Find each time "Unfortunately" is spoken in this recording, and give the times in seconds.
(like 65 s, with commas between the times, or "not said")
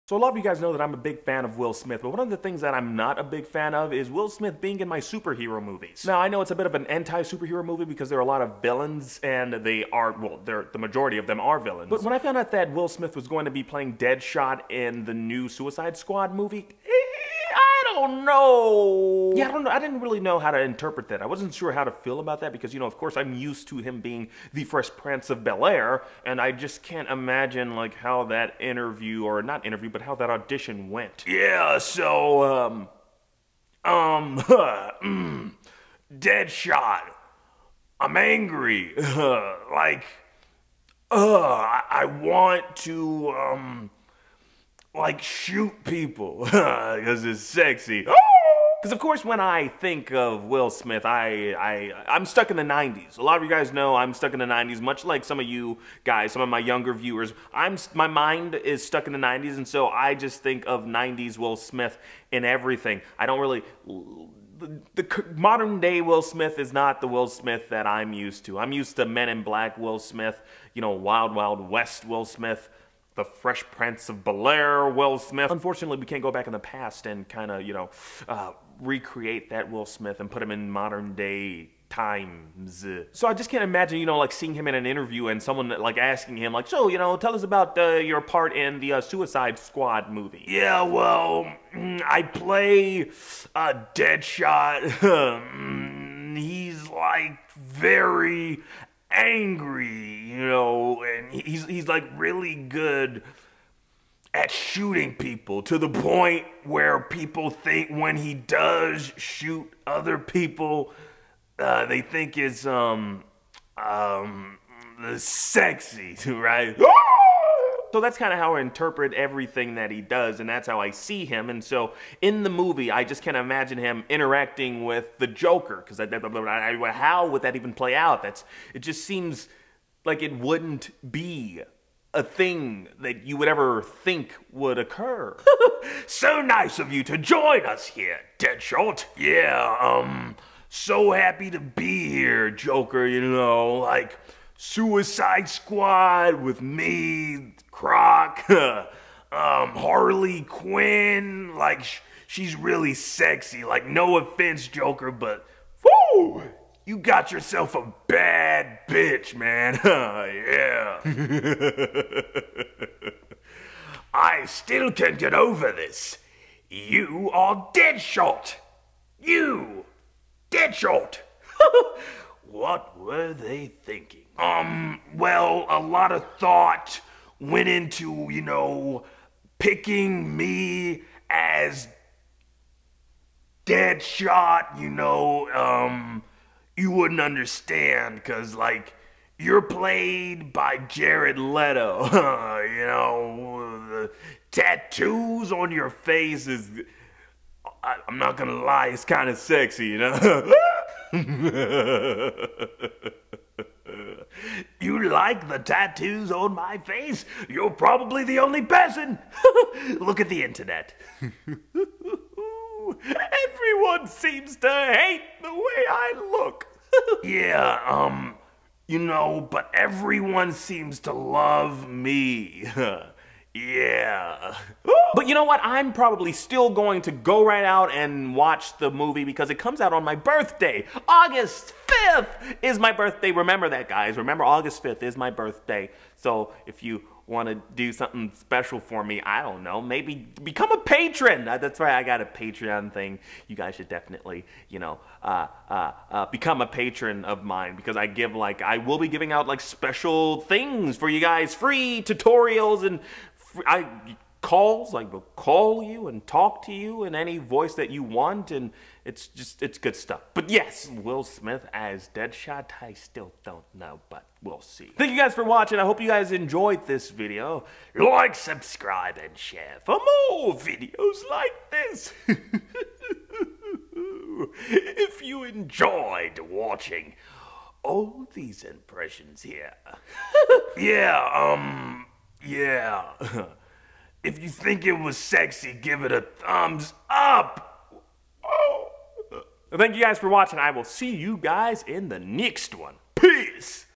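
75 s.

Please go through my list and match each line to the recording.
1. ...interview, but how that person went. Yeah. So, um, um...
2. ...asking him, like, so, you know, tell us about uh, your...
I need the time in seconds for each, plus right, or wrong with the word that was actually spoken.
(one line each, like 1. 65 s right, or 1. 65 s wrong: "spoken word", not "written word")
1. 29 s wrong: "audition", not "person"
2. 85 s right.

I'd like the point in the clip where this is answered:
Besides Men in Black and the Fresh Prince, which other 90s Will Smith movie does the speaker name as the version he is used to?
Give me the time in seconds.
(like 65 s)
70 s.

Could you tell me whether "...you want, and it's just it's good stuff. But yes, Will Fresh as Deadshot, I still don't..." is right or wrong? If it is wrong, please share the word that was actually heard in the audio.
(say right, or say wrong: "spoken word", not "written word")
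wrong: "Smith", not "Fresh".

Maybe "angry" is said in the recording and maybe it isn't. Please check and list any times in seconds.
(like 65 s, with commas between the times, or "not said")
38 s, 99 s.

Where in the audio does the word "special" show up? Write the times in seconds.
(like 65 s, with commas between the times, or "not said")
238 s, 249 s.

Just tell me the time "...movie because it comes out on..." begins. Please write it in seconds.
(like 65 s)
228 s.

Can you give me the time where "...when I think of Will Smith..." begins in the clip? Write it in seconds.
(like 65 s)
49 s.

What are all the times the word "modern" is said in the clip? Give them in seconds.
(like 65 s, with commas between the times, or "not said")
65 s, 80 s.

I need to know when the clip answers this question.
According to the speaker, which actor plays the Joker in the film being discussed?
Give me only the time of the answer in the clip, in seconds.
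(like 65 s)
190 s.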